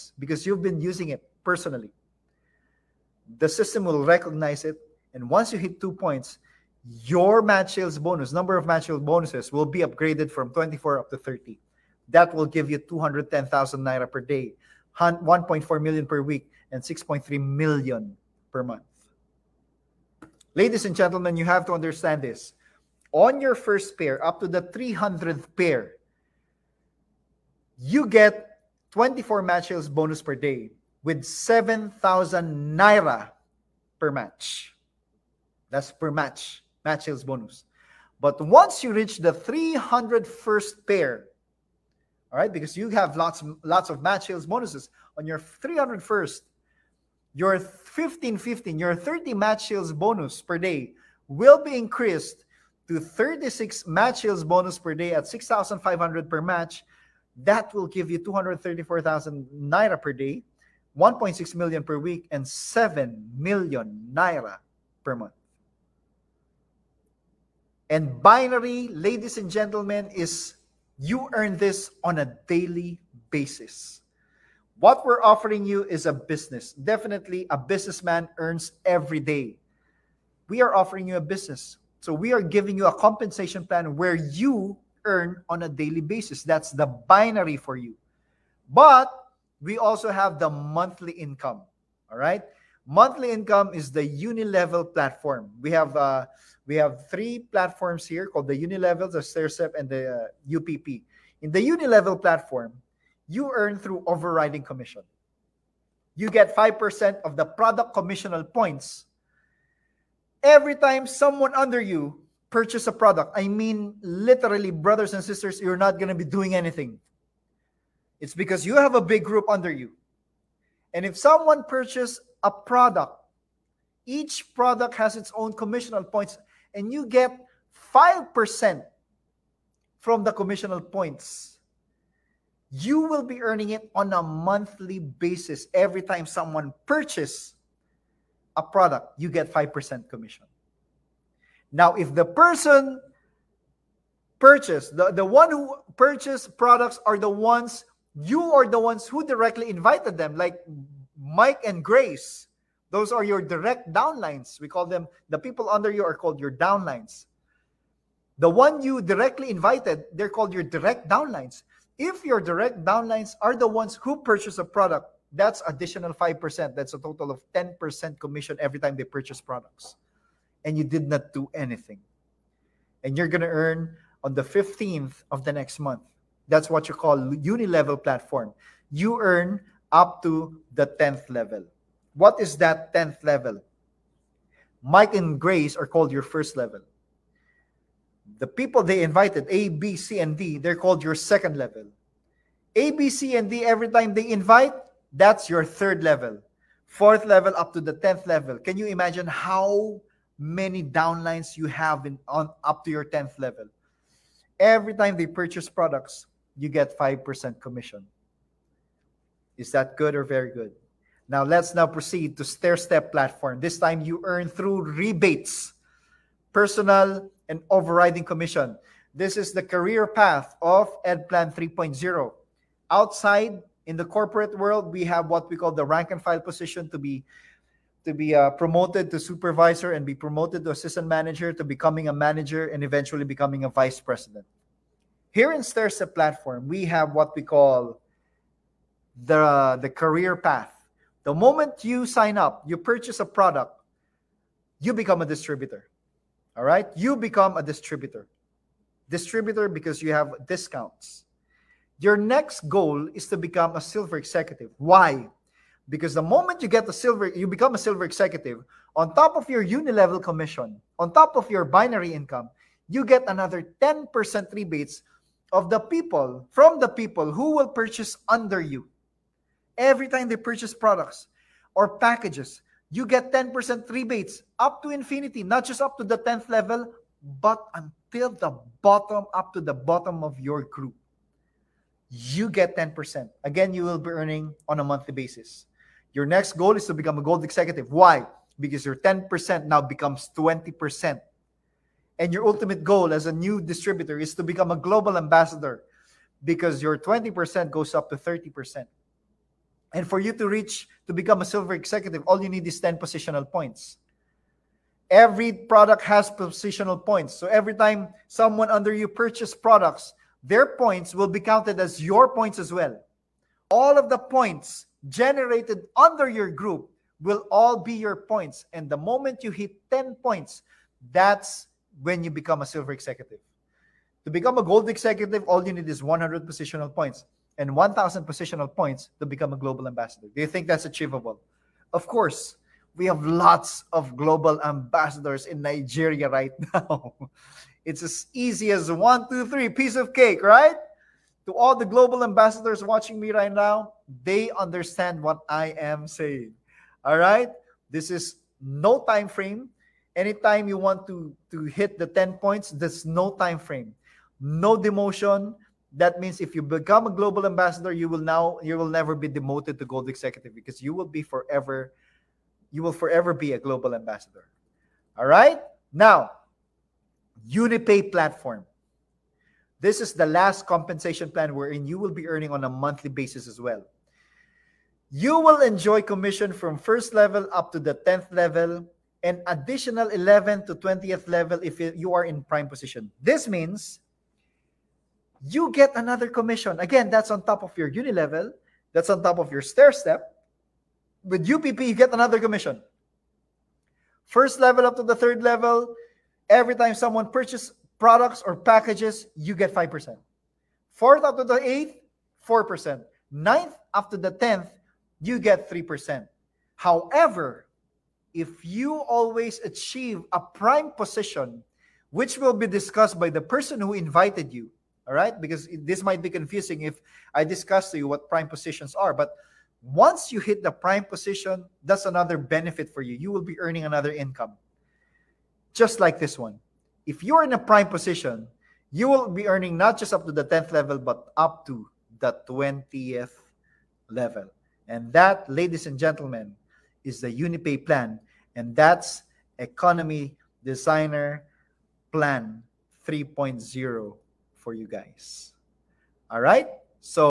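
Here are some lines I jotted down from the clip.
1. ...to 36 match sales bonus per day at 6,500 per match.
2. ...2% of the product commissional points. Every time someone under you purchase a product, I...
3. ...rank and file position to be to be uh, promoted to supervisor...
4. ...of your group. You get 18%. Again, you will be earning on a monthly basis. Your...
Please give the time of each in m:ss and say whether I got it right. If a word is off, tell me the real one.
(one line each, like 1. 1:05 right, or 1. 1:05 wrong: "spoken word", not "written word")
1. 0:52 right
2. 1:46 wrong: "5", not "2"
3. 3:45 right
4. 4:40 wrong: "10", not "18".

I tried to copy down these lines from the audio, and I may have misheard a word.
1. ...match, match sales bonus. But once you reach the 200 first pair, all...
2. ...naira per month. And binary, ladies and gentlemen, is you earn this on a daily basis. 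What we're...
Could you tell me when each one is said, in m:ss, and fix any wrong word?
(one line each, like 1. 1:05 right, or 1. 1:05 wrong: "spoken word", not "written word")
1. 0:36 wrong: "300", not "200"
2. 1:04 right.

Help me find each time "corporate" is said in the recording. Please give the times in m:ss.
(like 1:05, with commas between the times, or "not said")
3:44.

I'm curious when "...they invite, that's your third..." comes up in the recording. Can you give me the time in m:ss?
3:14.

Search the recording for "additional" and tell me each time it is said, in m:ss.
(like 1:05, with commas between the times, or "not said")
2:45, 6:19.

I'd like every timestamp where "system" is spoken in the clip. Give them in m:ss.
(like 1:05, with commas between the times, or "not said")
0:03.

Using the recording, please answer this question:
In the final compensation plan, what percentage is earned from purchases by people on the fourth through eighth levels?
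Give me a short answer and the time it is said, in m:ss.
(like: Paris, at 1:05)
4%, at 6:42.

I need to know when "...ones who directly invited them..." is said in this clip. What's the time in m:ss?
2:28.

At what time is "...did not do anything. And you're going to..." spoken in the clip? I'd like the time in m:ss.
2:50.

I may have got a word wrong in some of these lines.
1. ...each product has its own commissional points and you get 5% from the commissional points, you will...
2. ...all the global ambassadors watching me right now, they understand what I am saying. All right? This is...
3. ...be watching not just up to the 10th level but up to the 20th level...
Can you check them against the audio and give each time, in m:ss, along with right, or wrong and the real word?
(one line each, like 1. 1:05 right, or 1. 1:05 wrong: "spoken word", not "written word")
1. 2:04 right
2. 5:41 right
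3. 7:09 wrong: "earning", not "watching".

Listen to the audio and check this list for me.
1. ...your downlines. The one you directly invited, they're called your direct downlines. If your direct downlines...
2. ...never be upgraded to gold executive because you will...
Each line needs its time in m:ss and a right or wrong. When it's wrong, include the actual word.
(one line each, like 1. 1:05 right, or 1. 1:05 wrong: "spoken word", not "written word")
1. 2:36 right
2. 5:58 wrong: "demoted", not "upgraded".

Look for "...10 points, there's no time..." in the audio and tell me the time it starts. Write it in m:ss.
5:52.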